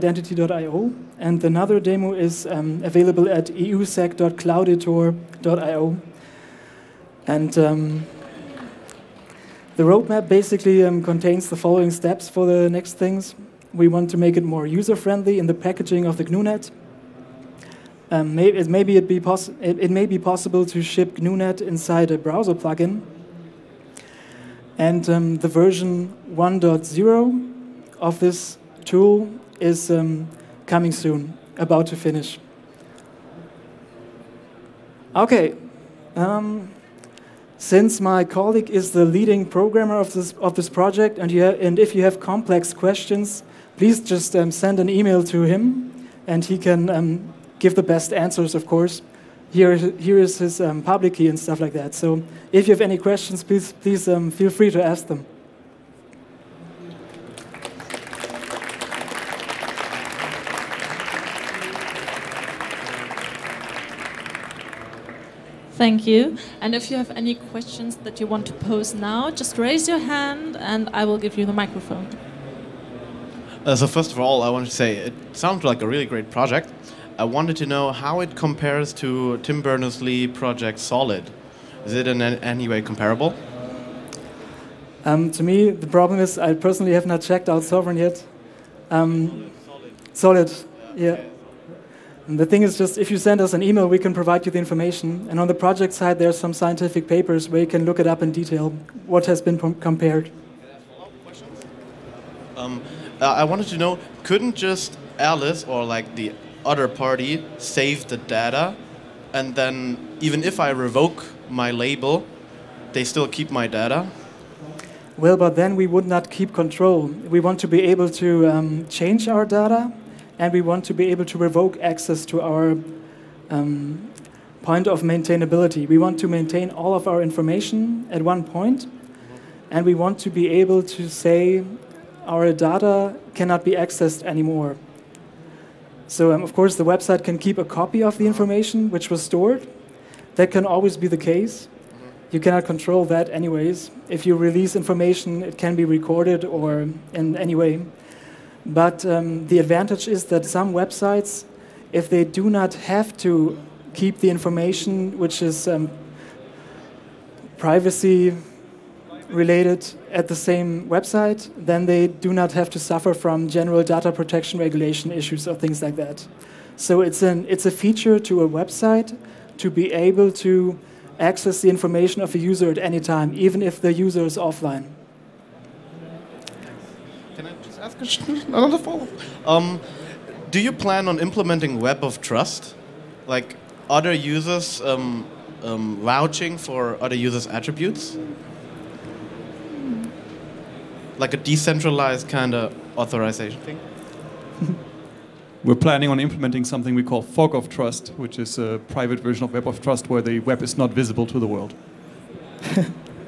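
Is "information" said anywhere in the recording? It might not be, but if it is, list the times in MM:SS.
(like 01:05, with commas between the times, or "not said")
01:34, 02:07, 02:18, 02:24, 02:34, 02:51.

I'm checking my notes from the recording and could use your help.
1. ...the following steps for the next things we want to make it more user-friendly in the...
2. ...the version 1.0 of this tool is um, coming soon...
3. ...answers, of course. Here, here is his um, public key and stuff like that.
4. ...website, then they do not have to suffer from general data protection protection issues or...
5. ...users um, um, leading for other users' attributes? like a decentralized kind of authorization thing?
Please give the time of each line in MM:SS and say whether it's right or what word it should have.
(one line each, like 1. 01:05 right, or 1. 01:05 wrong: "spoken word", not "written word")
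1. 00:11 right
2. 00:25 right
3. 00:48 right
4. 02:40 wrong: "regulation", not "protection"
5. 03:04 wrong: "vouching", not "leading".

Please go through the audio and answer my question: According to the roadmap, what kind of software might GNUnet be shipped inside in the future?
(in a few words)
A browser plugin.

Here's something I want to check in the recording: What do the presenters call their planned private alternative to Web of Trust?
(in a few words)
Fog of Trust.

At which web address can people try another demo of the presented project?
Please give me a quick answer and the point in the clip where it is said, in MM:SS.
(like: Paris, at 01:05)
eusec.clouditor.io, at 00:03.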